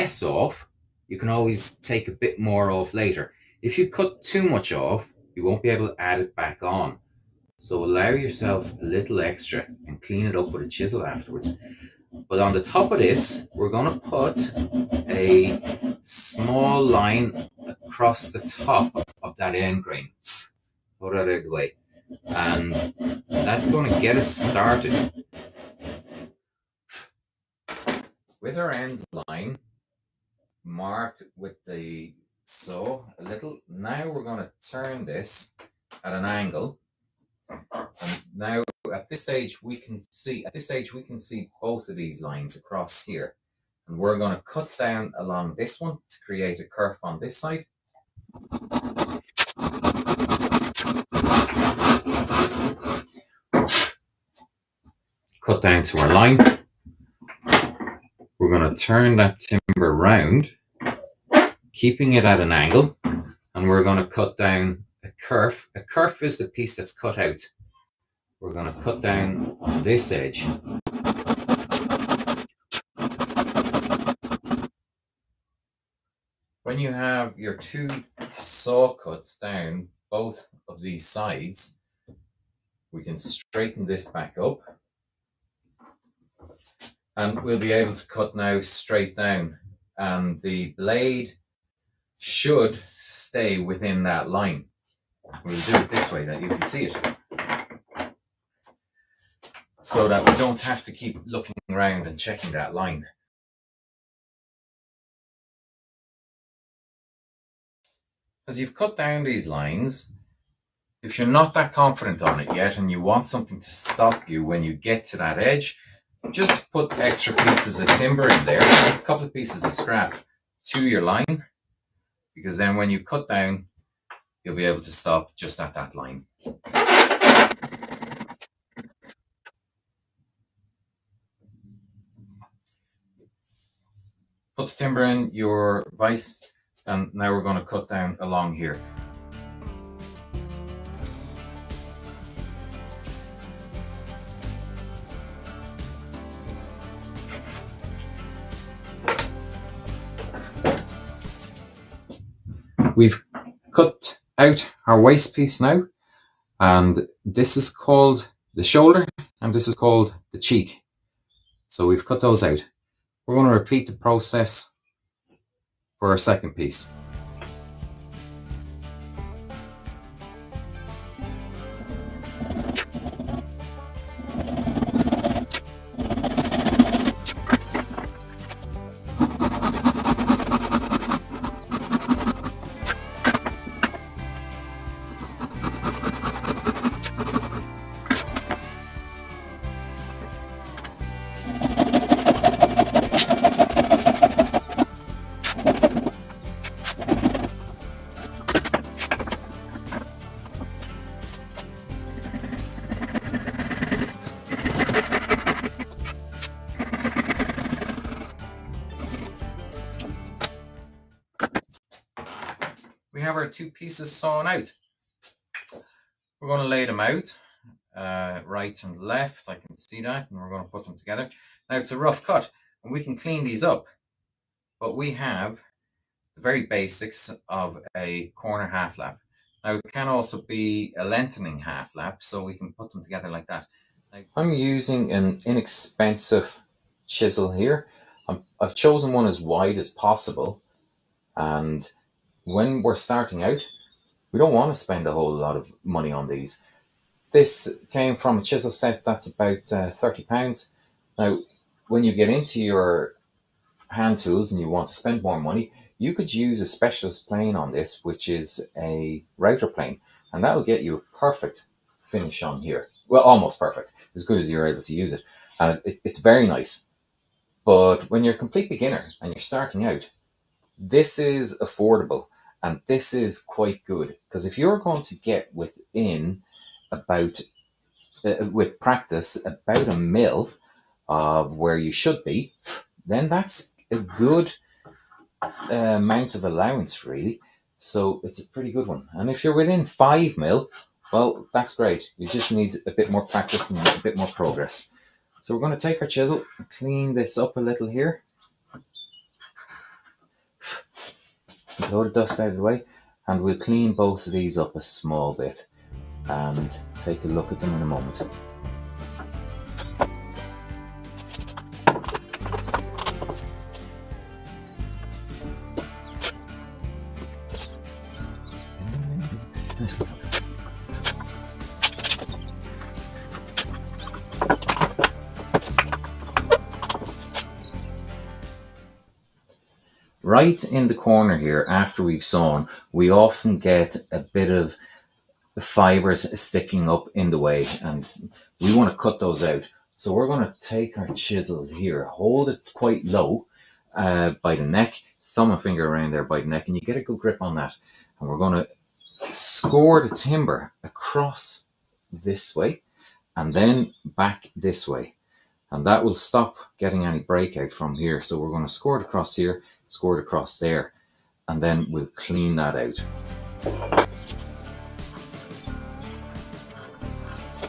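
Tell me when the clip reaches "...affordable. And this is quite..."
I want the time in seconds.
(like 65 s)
271 s.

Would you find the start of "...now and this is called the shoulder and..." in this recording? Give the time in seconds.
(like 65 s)
155 s.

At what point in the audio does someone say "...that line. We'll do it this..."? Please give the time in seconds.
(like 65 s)
94 s.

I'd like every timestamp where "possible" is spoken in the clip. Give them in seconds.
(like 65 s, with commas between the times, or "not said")
239 s.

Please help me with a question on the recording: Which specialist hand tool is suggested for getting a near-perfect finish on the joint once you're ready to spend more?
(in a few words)
Router plane.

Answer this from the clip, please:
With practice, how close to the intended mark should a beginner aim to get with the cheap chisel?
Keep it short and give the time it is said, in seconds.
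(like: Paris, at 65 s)
About 1 mm, at 279 s.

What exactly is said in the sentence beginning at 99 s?
So that we don't have to keep looking around and checking that line.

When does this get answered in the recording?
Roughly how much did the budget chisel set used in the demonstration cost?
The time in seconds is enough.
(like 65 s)
249 s.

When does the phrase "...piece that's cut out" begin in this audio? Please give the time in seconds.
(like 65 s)
66 s.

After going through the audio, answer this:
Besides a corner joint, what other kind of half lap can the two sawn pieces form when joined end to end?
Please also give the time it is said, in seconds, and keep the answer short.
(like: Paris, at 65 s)
Lengthening half lap, at 231 s.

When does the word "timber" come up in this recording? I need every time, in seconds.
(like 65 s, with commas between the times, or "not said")
59 s, 117 s, 134 s, 350 s.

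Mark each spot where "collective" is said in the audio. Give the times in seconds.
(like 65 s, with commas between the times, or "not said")
not said.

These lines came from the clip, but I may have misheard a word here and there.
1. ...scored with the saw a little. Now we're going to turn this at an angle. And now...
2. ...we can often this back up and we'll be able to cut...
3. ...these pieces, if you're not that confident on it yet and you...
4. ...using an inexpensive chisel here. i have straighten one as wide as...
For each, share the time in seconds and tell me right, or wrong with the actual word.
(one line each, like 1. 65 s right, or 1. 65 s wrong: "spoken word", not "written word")
1. 30 s wrong: "marked", not "scored"
2. 82 s wrong: "straighten", not "often"
3. 109 s wrong: "lines", not "pieces"
4. 234 s wrong: "chosen", not "straighten".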